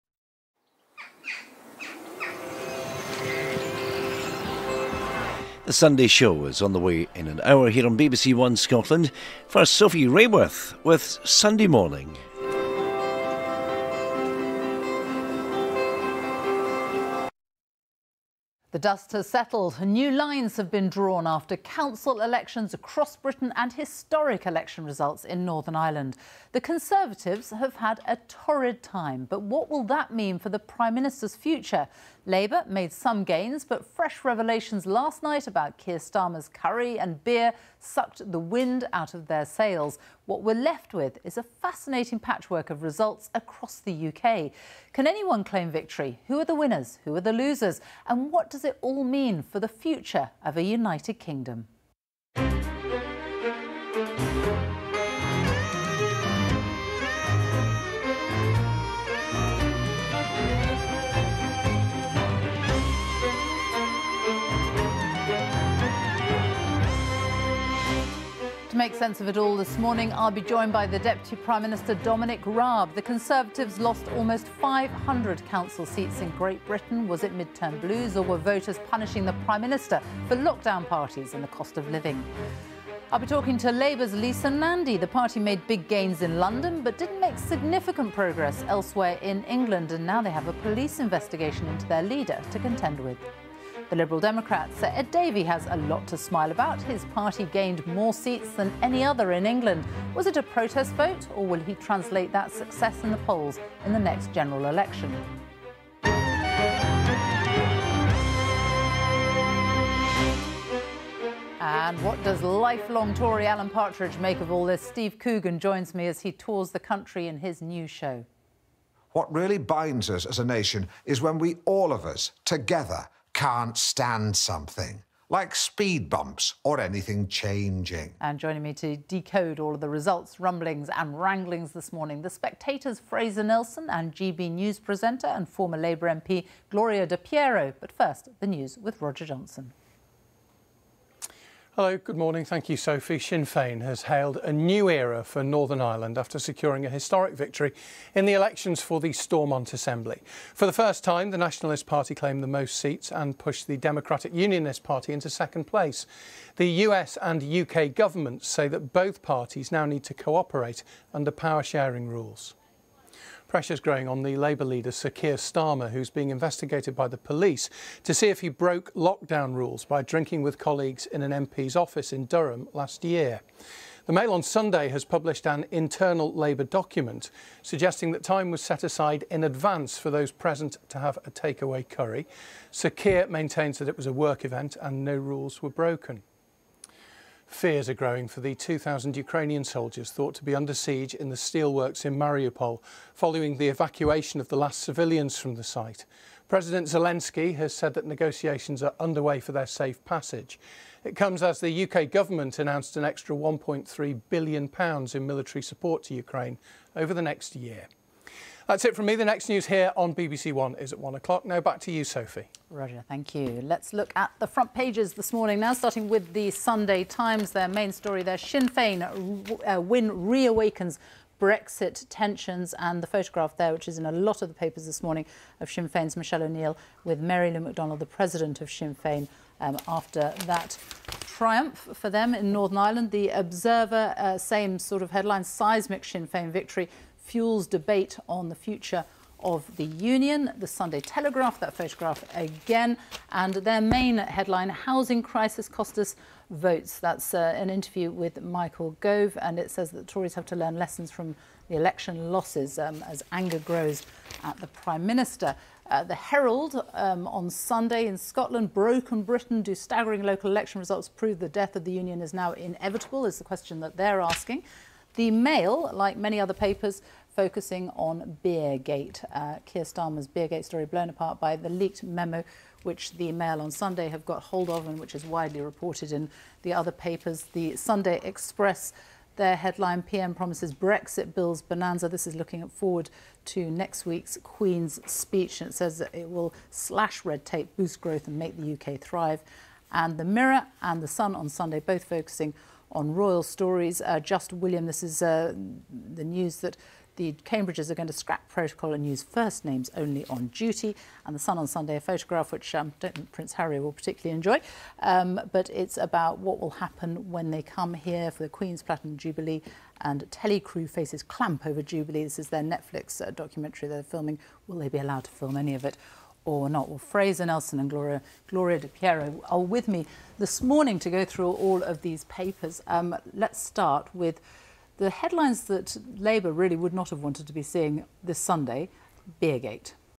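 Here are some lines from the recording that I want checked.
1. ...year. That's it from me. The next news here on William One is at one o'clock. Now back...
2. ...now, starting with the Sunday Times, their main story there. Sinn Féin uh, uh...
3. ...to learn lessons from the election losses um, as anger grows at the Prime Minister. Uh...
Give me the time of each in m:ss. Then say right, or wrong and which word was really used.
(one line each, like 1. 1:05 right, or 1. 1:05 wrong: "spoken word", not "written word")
1. 3:27 wrong: "BBC", not "William"
2. 3:35 right
3. 4:10 right.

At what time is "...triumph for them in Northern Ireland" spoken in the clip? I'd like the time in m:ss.
3:51.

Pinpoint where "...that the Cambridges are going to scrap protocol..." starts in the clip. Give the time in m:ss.
4:56.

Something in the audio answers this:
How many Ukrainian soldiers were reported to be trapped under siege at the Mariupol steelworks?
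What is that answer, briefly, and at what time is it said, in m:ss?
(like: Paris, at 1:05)
2,000, at 3:08.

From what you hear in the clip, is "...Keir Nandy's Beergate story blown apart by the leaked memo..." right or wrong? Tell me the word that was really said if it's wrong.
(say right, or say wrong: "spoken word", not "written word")
wrong: "Starmer", not "Nandy".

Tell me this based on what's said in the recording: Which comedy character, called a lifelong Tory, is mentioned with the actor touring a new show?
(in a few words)
Alan Partridge.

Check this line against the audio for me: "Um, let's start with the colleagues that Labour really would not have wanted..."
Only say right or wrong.
wrong.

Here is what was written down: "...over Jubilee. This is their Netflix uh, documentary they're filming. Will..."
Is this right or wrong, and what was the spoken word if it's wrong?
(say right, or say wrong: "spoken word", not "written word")
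right.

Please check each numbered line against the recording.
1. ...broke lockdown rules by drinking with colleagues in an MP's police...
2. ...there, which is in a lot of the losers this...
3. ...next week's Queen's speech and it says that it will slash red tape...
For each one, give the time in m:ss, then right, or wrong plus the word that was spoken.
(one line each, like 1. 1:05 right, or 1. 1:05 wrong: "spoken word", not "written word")
1. 2:48 wrong: "office", not "police"
2. 3:43 wrong: "papers", not "losers"
3. 4:43 right.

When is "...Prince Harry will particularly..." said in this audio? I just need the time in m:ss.
5:03.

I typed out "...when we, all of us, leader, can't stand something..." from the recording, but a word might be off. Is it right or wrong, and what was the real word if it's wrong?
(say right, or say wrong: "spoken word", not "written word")
wrong: "together", not "leader".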